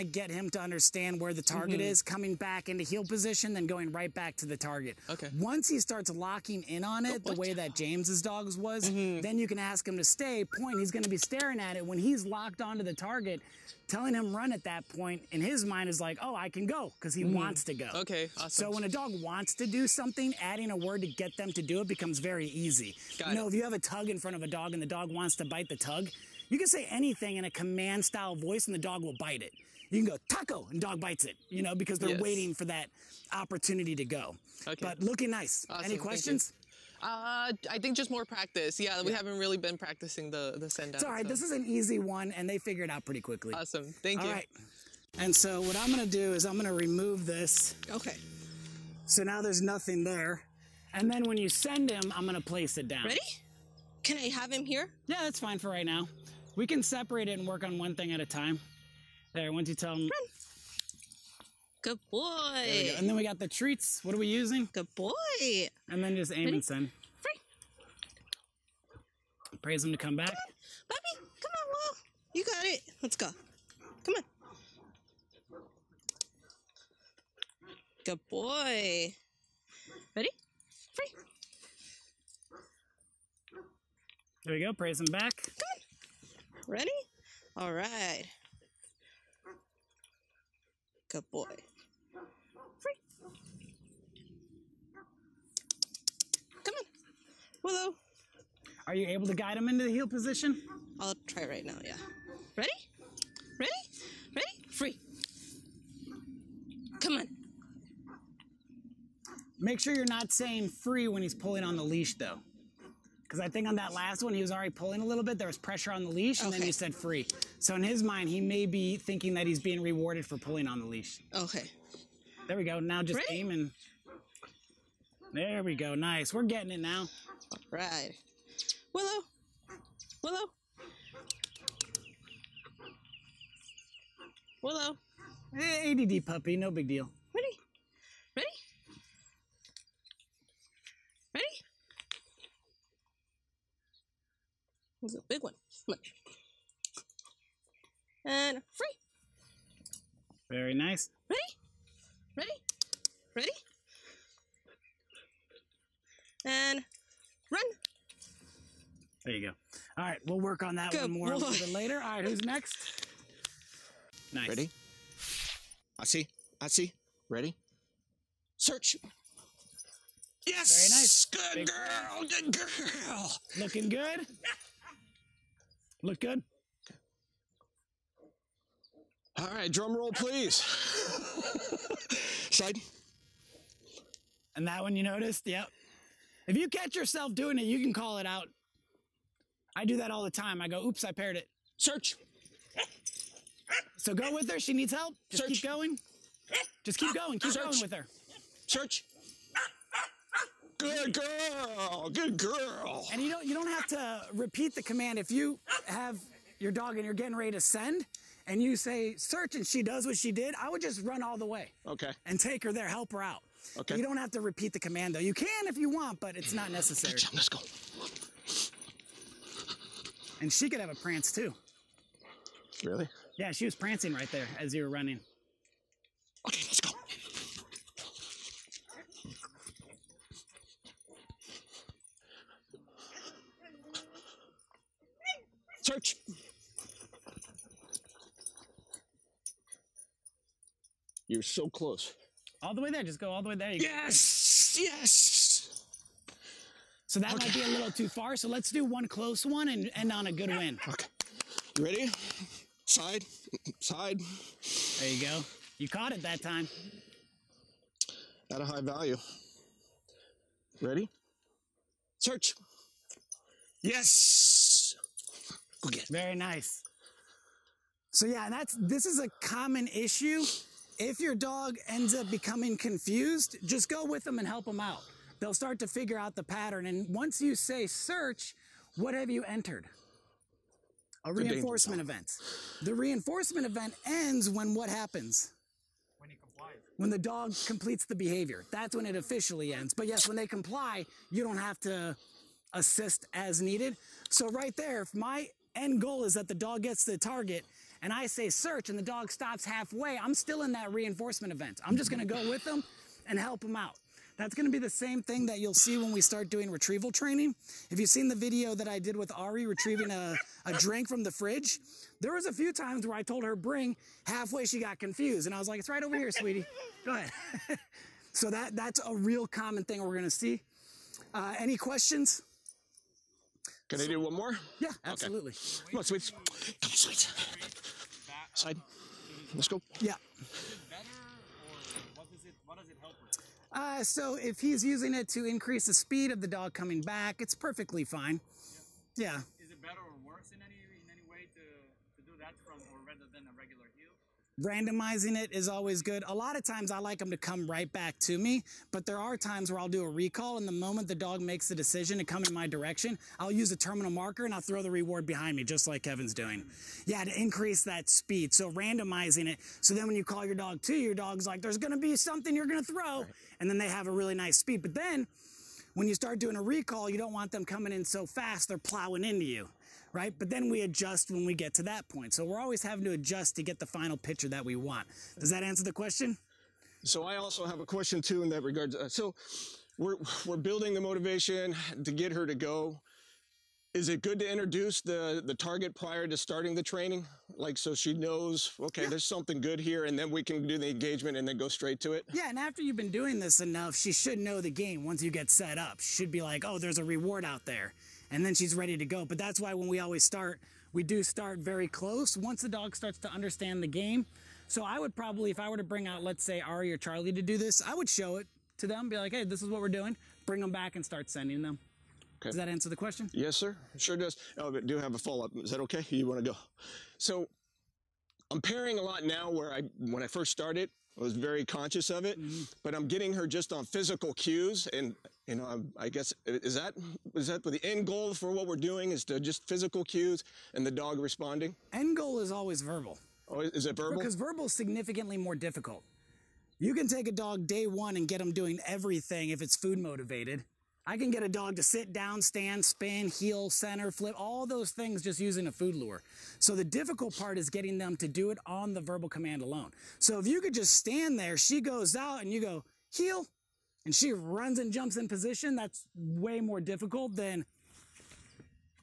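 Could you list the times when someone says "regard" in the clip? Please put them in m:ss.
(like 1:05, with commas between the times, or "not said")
6:18.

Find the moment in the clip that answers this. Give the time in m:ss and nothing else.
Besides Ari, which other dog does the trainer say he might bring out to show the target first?
6:46.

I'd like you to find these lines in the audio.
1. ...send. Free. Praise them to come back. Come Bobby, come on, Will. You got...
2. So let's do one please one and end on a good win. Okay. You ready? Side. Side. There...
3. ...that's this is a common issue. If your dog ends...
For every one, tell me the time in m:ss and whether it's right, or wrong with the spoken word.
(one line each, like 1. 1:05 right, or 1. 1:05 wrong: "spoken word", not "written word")
1. 1:06 right
2. 4:08 wrong: "close", not "please"
3. 4:28 right.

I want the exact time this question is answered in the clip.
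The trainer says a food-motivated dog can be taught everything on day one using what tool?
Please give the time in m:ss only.
7:25.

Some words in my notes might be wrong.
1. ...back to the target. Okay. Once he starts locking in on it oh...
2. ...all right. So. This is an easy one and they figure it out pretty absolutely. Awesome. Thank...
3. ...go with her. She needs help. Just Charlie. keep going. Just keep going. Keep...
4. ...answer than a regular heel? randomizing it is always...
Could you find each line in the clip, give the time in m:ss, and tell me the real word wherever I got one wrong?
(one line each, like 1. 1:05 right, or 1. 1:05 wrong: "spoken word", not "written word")
1. 0:04 right
2. 0:41 wrong: "quickly", not "absolutely"
3. 3:14 wrong: "Search", not "Charlie"
4. 5:43 wrong: "rather", not "answer".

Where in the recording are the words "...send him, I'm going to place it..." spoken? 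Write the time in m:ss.
0:51.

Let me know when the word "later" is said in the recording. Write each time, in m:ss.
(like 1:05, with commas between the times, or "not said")
2:41.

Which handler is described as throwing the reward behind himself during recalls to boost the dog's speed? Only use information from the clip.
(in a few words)
Kevin.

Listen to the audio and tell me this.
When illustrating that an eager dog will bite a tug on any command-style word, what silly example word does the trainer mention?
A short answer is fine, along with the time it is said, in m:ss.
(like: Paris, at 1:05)
taco, at 0:30.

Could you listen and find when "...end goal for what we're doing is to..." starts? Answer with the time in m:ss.
7:07.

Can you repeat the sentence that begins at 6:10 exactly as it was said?
But then we adjust when we get to that point.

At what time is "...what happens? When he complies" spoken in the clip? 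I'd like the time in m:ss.
4:44.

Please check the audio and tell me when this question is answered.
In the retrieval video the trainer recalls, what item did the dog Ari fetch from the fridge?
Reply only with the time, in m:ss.
5:10.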